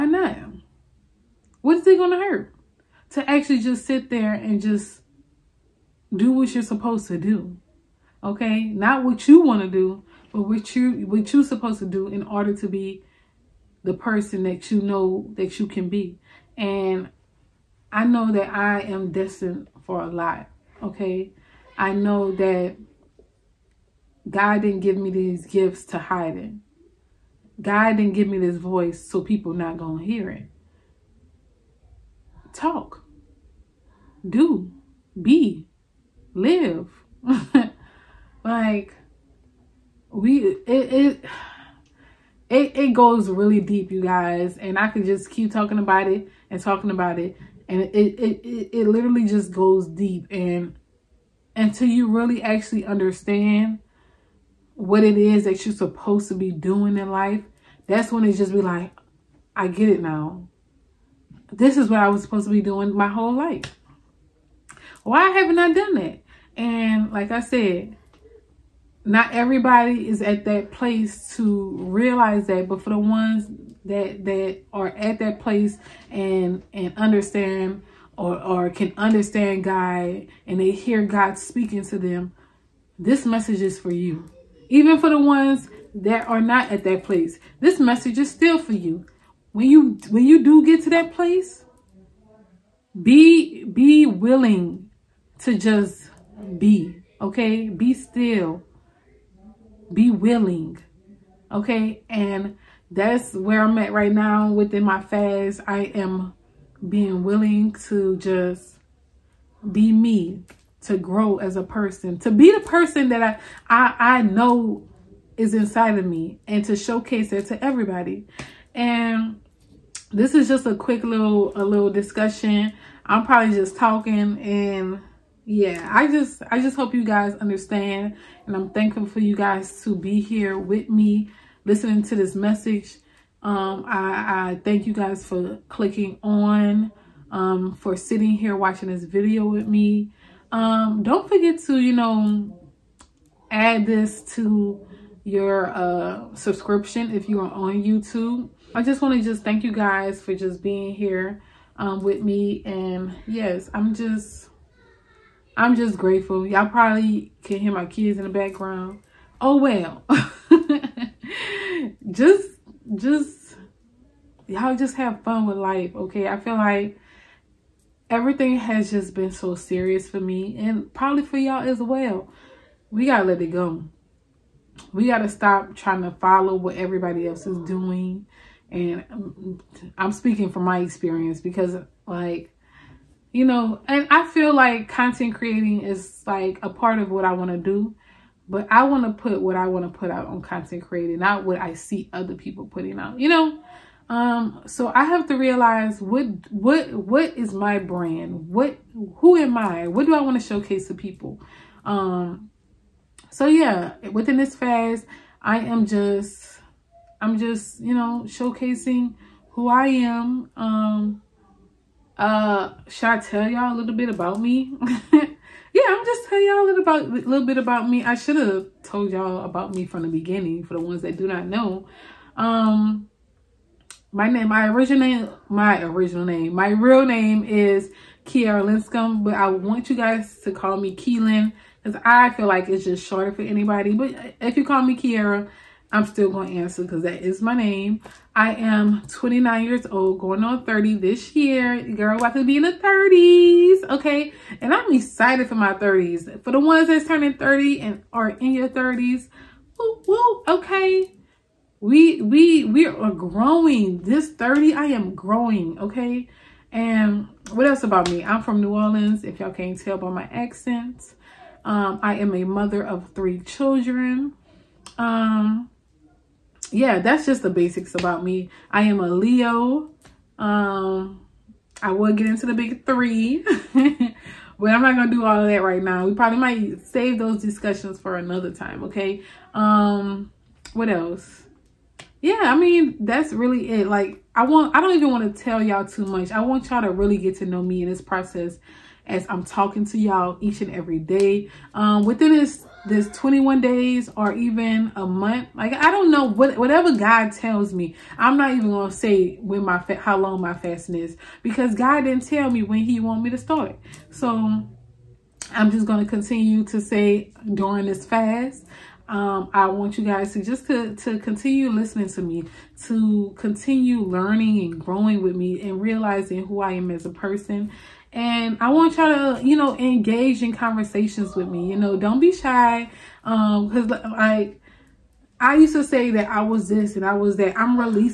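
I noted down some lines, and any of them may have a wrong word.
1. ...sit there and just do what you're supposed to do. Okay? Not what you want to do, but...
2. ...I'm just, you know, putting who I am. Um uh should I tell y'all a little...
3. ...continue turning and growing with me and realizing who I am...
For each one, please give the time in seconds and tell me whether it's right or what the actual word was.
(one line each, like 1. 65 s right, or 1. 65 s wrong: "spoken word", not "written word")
1. 3 s right
2. 207 s wrong: "showcasing", not "putting"
3. 313 s wrong: "learning", not "turning".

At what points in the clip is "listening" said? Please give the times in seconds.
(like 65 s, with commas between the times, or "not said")
131 s, 311 s.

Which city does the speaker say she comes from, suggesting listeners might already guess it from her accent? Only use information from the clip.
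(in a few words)
New Orleans.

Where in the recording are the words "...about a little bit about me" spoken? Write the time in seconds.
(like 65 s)
216 s.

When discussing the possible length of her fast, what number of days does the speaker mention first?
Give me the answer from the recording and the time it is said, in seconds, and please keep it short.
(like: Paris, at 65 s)
21, at 293 s.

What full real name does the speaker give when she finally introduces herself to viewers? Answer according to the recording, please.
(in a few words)
Kierra Linscomb.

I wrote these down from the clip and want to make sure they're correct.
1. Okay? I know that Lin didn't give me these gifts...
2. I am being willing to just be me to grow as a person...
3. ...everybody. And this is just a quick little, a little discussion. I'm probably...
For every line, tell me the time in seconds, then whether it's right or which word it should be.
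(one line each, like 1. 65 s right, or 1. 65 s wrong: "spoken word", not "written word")
1. 20 s wrong: "God", not "Lin"
2. 105 s right
3. 117 s right.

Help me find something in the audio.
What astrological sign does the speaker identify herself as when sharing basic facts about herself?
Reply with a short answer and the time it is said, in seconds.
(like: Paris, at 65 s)
Leo, at 269 s.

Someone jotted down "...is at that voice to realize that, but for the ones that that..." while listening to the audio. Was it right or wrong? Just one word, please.
wrong.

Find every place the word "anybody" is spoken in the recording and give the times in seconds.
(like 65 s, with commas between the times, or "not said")
233 s.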